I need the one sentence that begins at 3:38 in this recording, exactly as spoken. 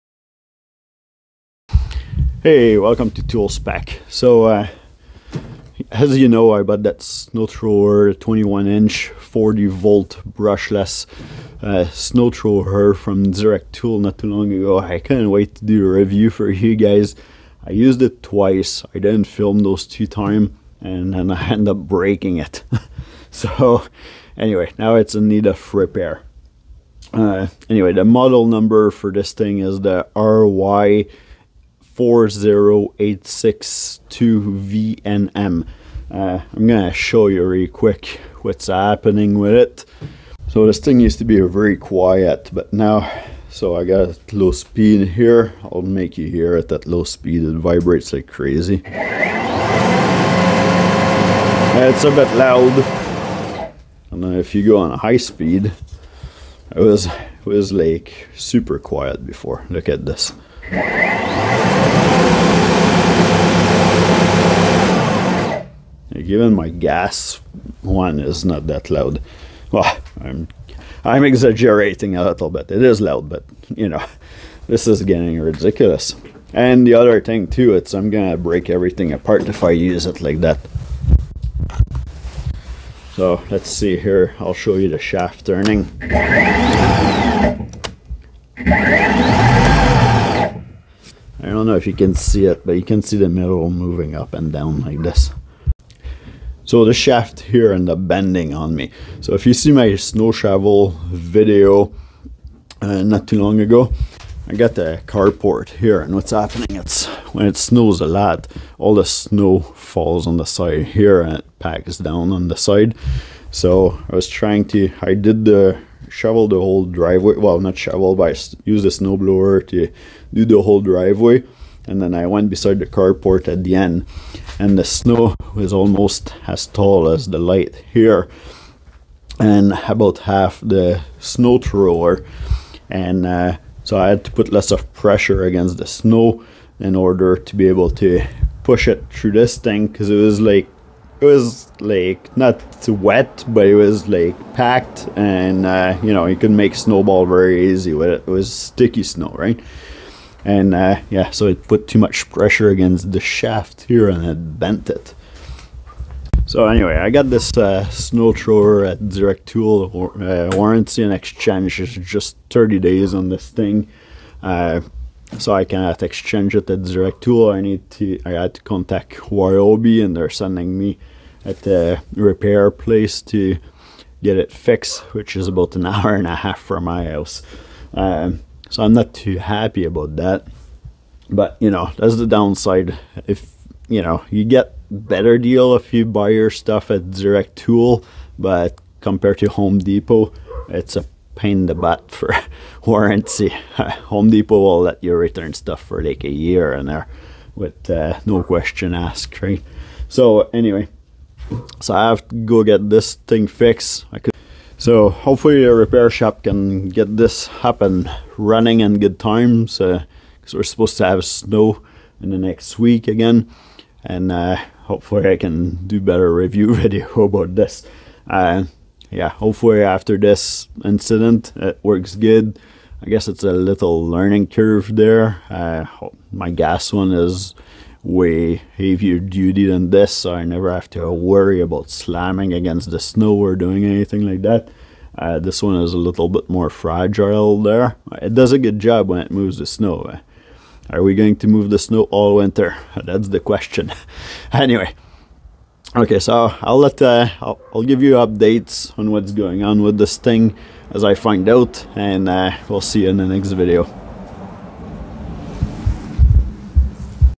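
Uh, yeah, hopefully after this incident it works good.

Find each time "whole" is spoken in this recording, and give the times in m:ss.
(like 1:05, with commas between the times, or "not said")
1:56, 2:00.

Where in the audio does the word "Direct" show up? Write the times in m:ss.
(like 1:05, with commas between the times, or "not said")
0:13, 2:39, 2:46, 3:07.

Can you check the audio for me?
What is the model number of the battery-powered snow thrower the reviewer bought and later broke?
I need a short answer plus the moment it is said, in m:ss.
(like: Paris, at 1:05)
RY40862VNM, at 0:30.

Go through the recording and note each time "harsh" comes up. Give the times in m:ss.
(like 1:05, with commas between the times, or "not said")
not said.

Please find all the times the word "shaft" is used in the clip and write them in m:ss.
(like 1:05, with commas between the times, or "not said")
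1:24, 1:36, 2:33.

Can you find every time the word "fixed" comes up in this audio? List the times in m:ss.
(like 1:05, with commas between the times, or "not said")
2:54, 3:23.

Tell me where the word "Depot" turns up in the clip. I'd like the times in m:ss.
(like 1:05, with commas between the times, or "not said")
3:09, 3:14.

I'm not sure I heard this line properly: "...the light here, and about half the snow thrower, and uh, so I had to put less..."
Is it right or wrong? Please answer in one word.
right.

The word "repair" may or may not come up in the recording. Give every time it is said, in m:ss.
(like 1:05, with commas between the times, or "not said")
0:25, 2:52, 3:25.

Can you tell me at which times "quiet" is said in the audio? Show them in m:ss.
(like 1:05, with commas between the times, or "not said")
0:41, 0:58.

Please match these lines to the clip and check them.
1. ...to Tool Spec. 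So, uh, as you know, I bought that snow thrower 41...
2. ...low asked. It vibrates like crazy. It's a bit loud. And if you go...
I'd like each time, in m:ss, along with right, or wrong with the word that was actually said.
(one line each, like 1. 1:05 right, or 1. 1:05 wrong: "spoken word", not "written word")
1. 0:03 wrong: "21", not "41"
2. 0:46 wrong: "speed", not "asked".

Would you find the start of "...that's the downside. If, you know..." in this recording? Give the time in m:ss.
3:01.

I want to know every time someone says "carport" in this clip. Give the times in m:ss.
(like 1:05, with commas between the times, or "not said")
1:45, 2:02.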